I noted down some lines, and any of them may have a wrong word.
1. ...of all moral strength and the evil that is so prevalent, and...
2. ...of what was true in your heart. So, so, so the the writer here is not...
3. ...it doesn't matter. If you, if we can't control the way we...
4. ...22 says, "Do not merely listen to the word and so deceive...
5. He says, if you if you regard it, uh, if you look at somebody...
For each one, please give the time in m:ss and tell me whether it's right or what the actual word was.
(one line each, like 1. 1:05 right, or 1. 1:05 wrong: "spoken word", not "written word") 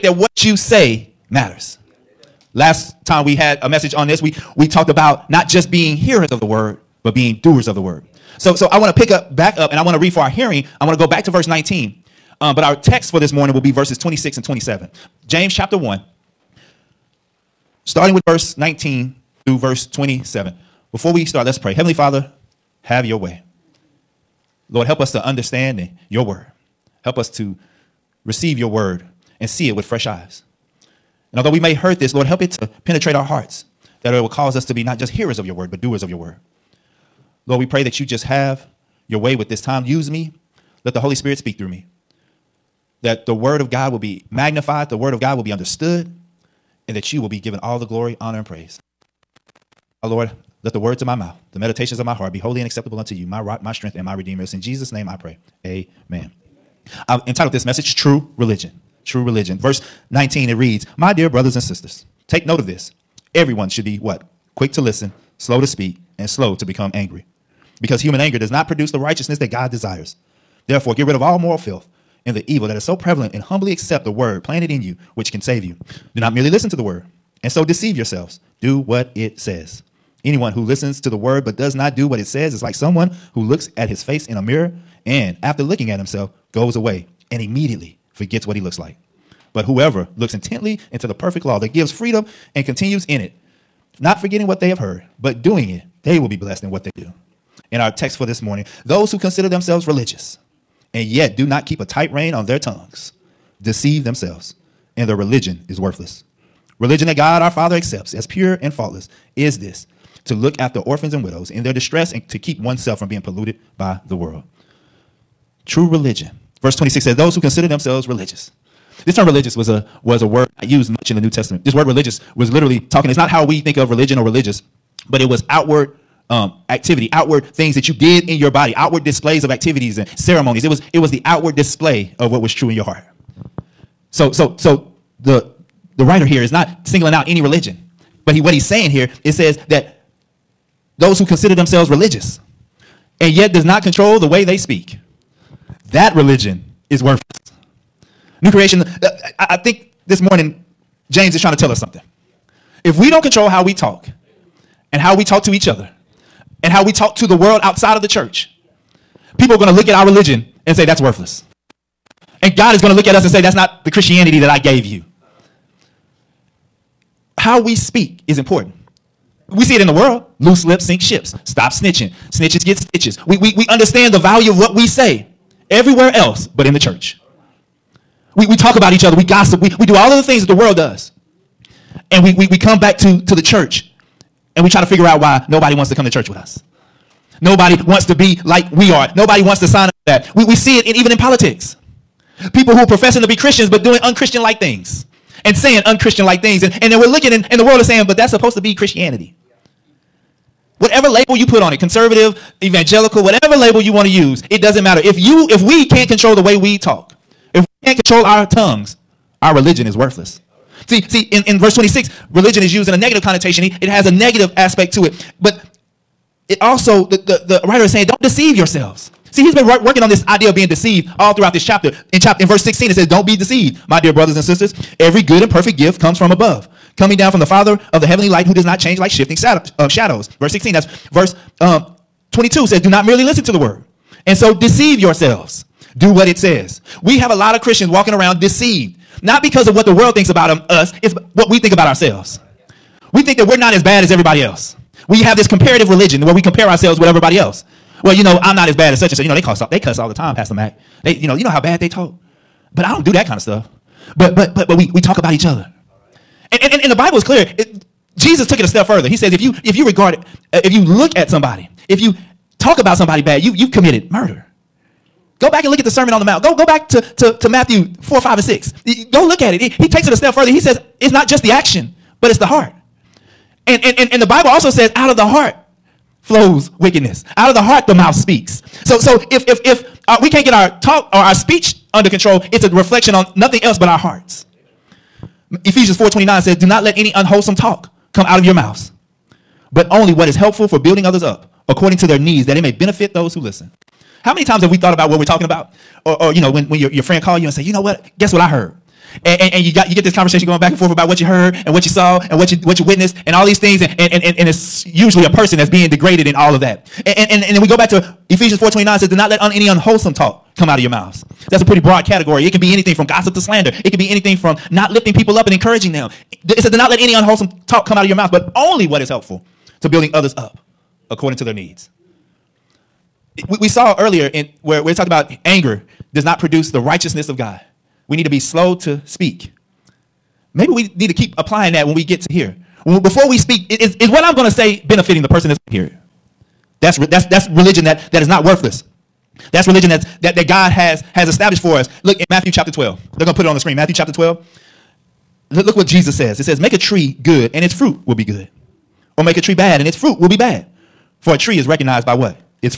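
1. 1:11 wrong: "filth", not "strength"
2. 2:12 right
3. 3:24 right
4. 3:52 right
5. 4:19 right.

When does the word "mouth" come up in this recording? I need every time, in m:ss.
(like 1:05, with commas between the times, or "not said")
0:51, 4:37, 4:48, 5:10, 5:18.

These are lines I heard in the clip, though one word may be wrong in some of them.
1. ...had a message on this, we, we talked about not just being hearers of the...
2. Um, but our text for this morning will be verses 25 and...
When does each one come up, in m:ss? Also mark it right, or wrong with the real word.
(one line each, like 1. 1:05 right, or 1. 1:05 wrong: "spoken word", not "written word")
1. 0:03 right
2. 0:12 wrong: "26", not "25".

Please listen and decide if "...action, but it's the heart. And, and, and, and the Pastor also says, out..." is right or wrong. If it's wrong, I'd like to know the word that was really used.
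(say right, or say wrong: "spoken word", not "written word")
wrong: "Bible", not "Pastor".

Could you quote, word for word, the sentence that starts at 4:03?
We think that we're not as bad as everybody else.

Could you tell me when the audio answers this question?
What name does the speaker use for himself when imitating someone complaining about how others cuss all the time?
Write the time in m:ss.
4:10.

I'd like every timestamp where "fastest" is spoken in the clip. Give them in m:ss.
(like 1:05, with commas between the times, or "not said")
not said.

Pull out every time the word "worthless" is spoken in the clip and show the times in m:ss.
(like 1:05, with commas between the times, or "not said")
1:45, 2:27, 2:40, 3:29, 5:38.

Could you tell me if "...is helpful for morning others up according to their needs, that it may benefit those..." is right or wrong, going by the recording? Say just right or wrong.
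wrong.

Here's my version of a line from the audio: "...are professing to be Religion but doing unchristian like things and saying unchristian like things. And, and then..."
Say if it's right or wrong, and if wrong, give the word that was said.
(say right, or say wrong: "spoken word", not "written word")
wrong: "Christians", not "Religion".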